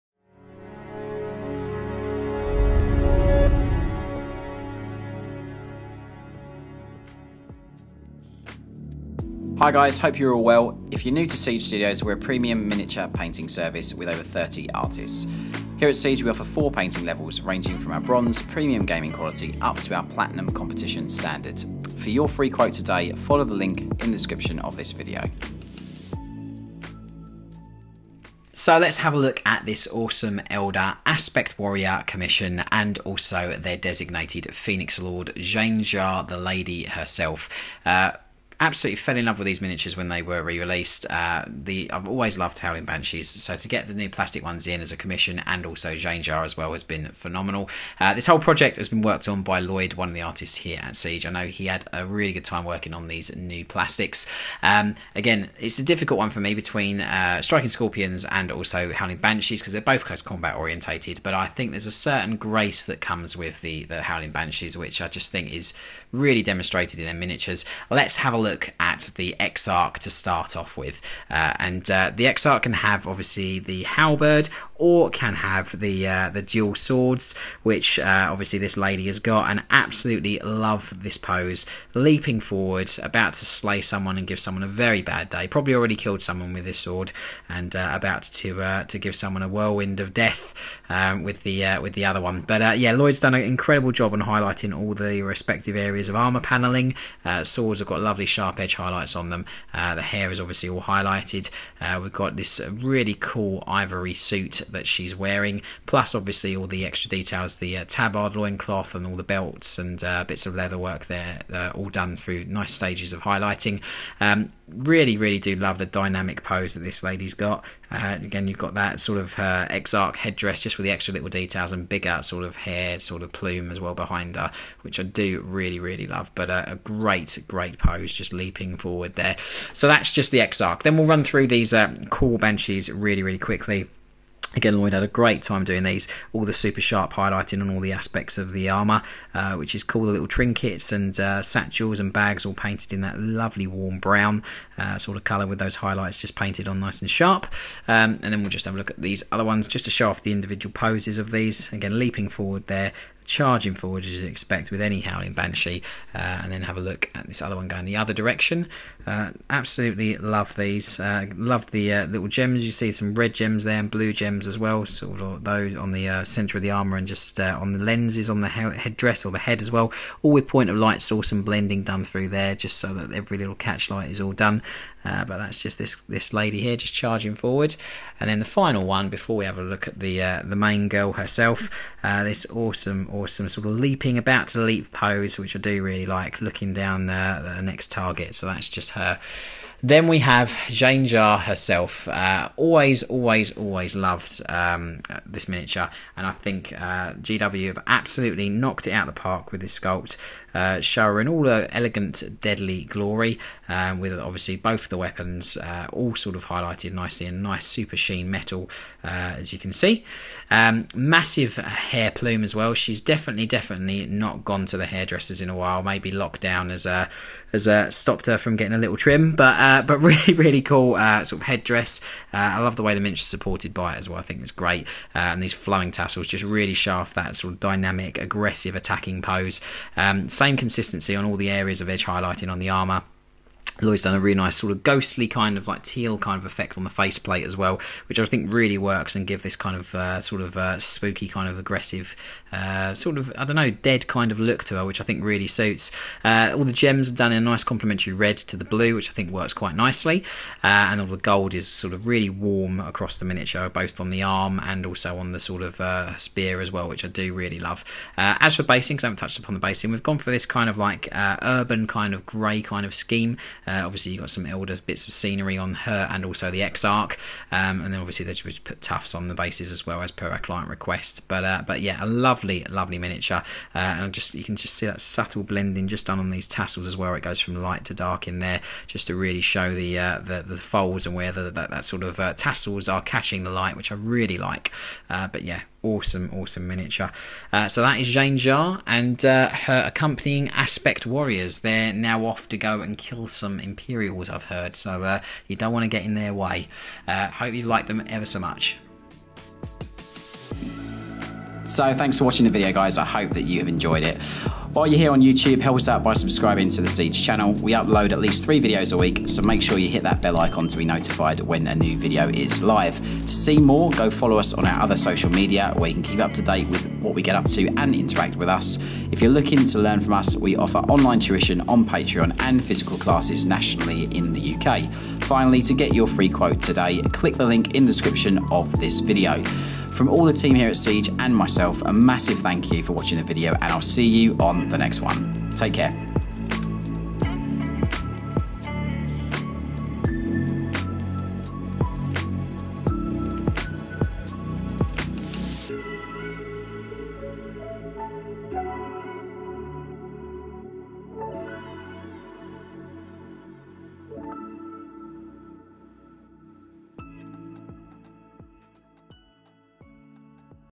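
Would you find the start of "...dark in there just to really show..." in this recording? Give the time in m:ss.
4:37.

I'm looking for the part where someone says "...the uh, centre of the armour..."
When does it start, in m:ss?
2:45.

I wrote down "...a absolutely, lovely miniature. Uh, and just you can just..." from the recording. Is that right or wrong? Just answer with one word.
wrong.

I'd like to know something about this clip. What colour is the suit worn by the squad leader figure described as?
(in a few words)
ivory.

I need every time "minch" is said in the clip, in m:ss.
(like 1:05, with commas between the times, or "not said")
3:43.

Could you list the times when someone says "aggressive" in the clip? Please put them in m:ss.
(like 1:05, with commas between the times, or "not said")
3:48, 4:01.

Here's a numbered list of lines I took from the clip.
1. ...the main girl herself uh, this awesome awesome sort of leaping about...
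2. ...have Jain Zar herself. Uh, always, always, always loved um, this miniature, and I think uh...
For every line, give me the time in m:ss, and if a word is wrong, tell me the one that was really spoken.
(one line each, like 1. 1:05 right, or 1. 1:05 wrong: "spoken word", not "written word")
1. 3:00 right
2. 3:10 right.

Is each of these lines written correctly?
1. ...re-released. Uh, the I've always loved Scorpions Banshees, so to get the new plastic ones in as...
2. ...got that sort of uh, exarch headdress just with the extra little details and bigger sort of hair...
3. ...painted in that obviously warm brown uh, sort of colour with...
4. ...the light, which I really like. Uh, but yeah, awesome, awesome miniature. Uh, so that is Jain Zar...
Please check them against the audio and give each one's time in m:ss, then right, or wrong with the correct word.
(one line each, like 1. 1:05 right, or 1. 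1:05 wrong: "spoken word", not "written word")
1. 0:40 wrong: "Howling", not "Scorpions"
2. 1:58 right
3. 2:22 wrong: "lovely", not "obviously"
4. 4:43 right.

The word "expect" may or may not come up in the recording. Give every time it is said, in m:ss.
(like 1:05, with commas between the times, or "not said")
2:34.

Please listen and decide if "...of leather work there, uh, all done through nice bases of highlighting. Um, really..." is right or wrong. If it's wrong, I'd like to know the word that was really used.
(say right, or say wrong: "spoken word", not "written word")
wrong: "stages", not "bases".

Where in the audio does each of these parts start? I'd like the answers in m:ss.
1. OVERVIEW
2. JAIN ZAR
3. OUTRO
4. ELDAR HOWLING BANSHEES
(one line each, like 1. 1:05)
1. 0:28
2. 3:11
3. 5:00
4. 1:10.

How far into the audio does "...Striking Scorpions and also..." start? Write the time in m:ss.
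0:57.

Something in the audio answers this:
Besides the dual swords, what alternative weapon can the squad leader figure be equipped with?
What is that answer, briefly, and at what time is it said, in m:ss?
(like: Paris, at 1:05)
Halberd, at 1:13.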